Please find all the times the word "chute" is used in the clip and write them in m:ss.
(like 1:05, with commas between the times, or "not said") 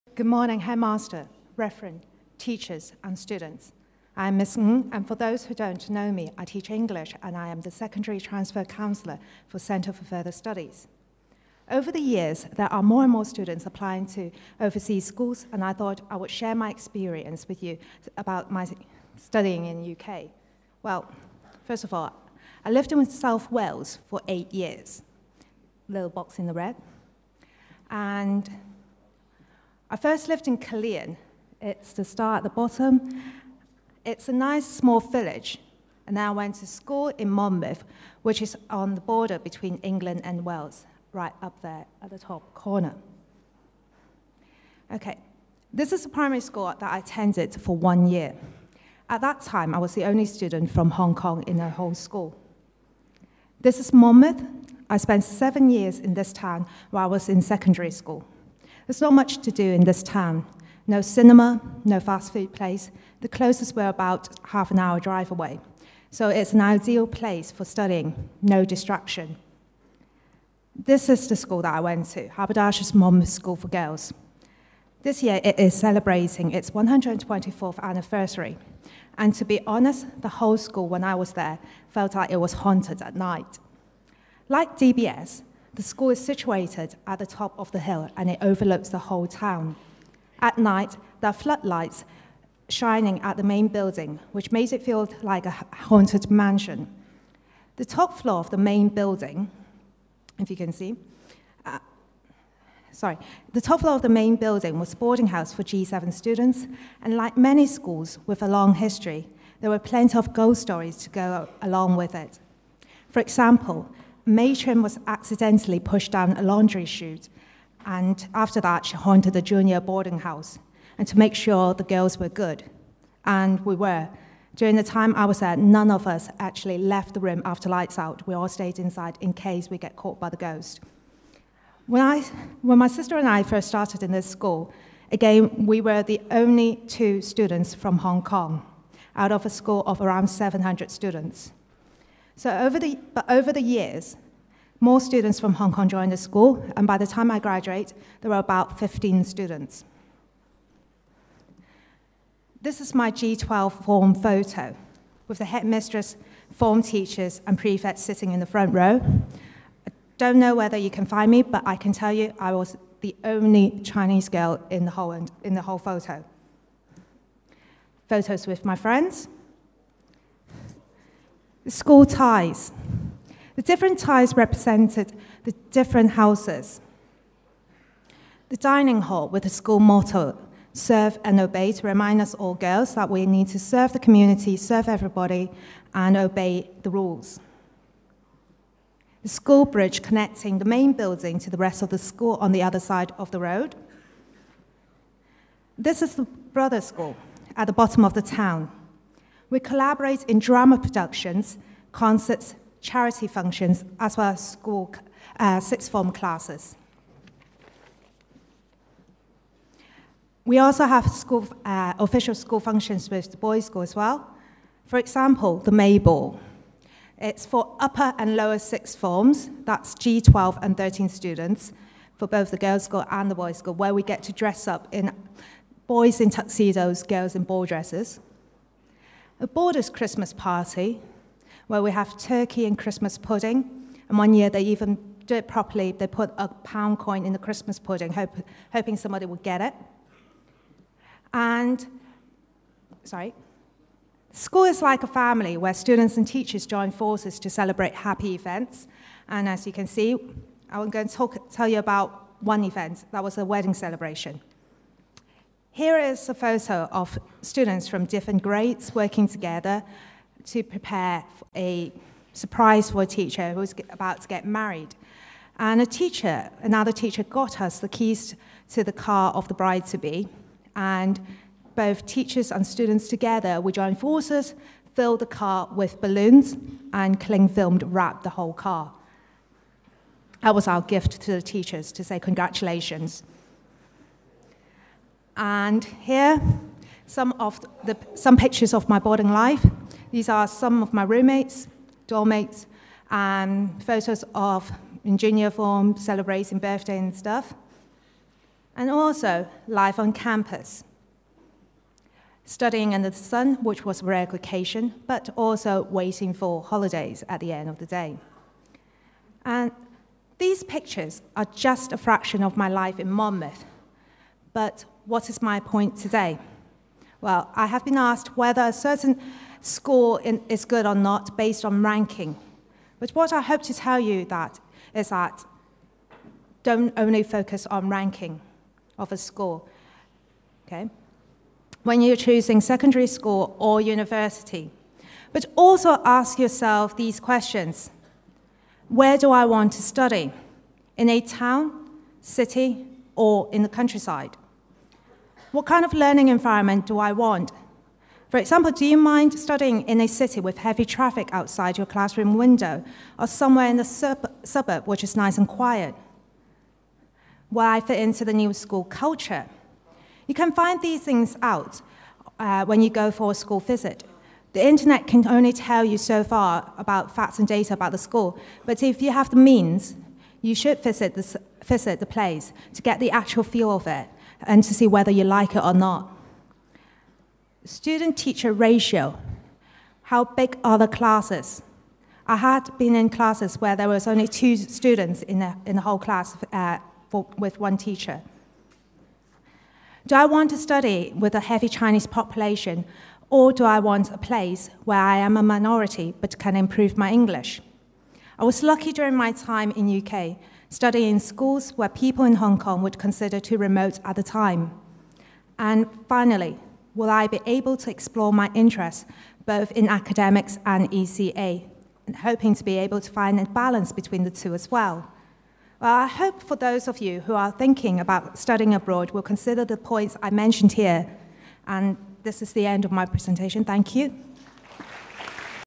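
1:56.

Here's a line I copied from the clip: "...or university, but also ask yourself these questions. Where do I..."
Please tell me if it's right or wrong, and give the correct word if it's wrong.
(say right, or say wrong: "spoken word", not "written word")
right.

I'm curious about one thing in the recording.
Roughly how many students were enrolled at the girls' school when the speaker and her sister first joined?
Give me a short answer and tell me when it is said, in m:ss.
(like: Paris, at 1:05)
700, at 2:20.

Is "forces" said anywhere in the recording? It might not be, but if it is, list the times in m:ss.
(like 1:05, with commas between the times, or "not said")
4:06, 4:33.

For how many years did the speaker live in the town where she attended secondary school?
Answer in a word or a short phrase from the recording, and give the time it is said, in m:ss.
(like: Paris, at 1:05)
7, at 0:55.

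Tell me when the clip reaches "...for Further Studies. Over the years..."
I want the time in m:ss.
0:09.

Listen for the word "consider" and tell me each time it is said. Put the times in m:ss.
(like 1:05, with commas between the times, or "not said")
6:42, 6:59.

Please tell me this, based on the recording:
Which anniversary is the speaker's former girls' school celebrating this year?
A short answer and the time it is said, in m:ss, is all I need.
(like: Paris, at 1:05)
124th, at 1:16.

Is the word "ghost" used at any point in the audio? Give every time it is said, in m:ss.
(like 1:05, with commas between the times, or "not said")
1:50, 2:10.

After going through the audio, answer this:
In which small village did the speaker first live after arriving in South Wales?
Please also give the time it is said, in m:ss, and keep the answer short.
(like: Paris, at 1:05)
Caerleon, at 0:30.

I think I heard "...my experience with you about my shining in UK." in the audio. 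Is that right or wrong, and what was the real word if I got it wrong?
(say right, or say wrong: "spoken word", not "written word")
wrong: "studying", not "shining".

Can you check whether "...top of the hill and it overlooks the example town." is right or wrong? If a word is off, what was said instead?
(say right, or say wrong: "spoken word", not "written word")
wrong: "whole", not "example".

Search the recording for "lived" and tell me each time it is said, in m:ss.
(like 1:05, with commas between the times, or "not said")
0:22, 0:30.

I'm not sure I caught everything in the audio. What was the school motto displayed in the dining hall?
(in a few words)
Serve and obey.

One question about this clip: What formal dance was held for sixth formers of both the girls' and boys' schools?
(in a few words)
May Ball.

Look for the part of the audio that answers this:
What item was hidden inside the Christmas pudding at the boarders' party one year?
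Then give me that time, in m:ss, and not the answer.
3:56.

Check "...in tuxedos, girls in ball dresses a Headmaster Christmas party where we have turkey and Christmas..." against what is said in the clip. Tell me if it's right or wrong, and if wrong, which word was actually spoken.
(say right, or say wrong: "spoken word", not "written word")
wrong: "Boarders", not "Headmaster".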